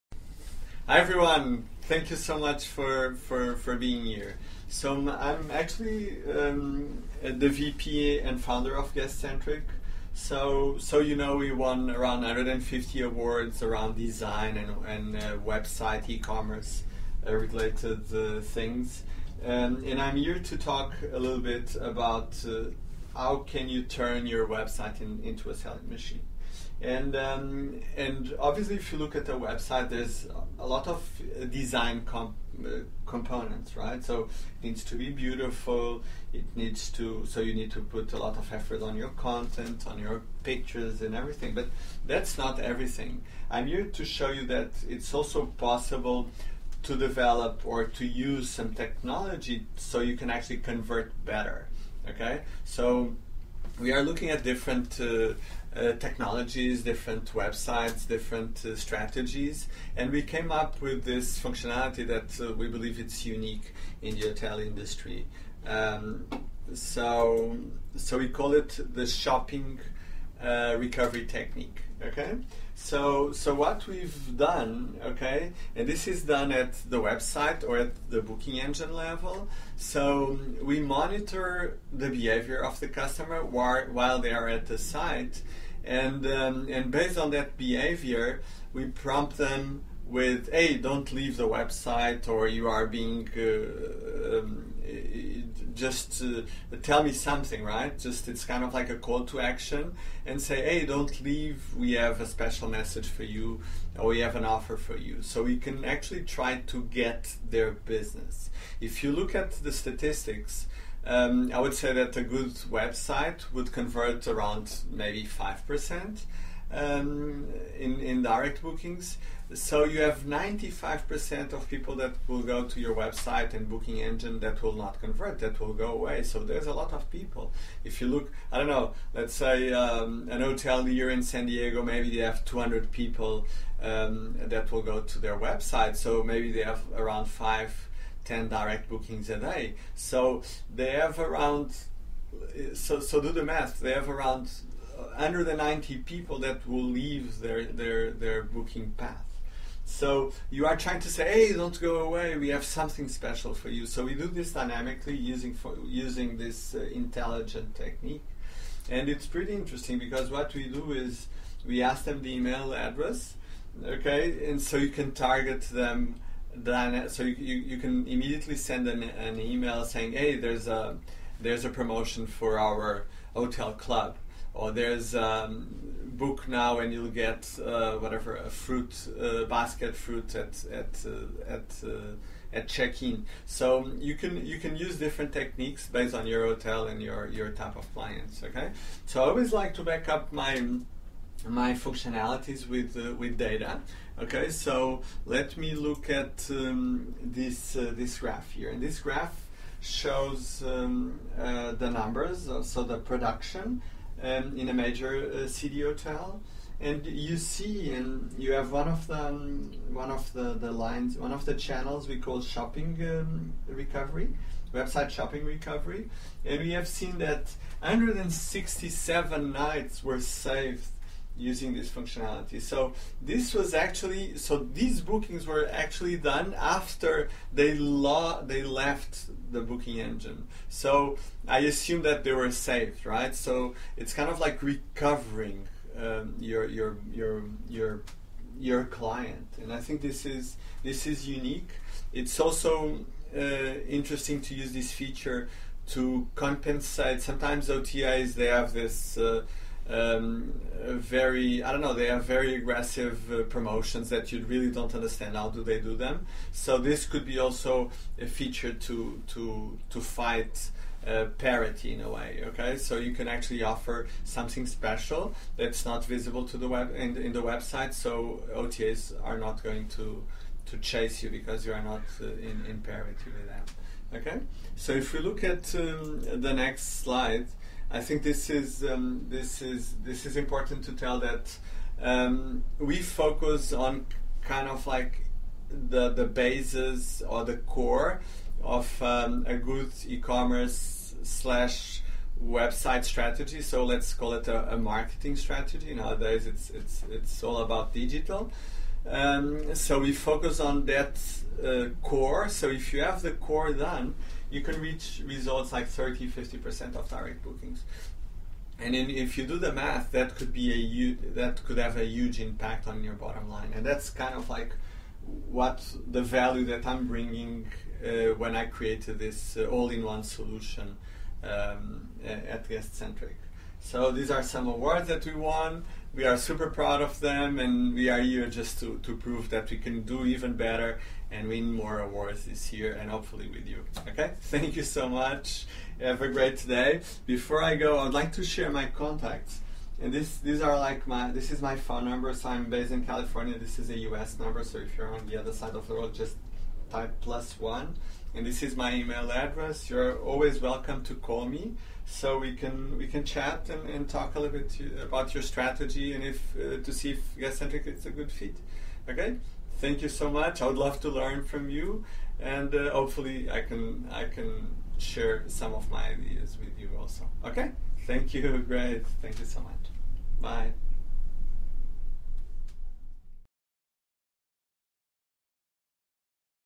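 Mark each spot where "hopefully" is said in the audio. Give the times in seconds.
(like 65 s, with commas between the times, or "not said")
333 s, 362 s.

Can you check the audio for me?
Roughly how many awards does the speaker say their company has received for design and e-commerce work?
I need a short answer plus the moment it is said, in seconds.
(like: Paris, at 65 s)
150, at 12 s.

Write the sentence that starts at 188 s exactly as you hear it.
Okay, so I always like to back up my my functionalities with uh, with data.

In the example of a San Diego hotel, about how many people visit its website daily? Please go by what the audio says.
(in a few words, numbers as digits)
200.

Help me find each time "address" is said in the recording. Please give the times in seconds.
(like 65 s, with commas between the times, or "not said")
162 s, 349 s.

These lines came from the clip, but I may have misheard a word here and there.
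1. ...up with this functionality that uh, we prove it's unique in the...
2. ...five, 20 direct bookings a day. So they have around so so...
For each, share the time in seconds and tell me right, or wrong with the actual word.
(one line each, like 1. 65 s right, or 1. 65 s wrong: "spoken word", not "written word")
1. 60 s wrong: "believe", not "prove"
2. 137 s wrong: "10", not "20".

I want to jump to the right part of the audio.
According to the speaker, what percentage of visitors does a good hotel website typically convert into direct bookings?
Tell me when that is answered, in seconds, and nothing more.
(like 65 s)
115 s.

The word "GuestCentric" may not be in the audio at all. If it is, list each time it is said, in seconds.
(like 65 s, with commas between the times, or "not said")
8 s, 322 s, 357 s.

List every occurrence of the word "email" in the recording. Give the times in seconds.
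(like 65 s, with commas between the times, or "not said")
162 s, 169 s, 348 s.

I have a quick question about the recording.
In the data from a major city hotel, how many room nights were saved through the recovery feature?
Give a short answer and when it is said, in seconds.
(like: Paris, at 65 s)
167, at 217 s.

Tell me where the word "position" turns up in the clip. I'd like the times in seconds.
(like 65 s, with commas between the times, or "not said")
not said.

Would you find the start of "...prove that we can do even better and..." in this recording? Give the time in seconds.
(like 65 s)
329 s.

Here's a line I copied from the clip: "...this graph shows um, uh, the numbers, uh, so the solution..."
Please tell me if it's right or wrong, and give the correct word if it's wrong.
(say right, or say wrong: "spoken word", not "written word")
wrong: "production", not "solution".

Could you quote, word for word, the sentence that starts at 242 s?
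It's also uh, interesting to use this feature to compensate.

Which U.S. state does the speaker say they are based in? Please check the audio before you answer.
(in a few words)
California.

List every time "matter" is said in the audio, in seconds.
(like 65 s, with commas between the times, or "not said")
not said.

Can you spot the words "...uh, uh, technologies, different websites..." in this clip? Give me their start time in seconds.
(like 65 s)
55 s.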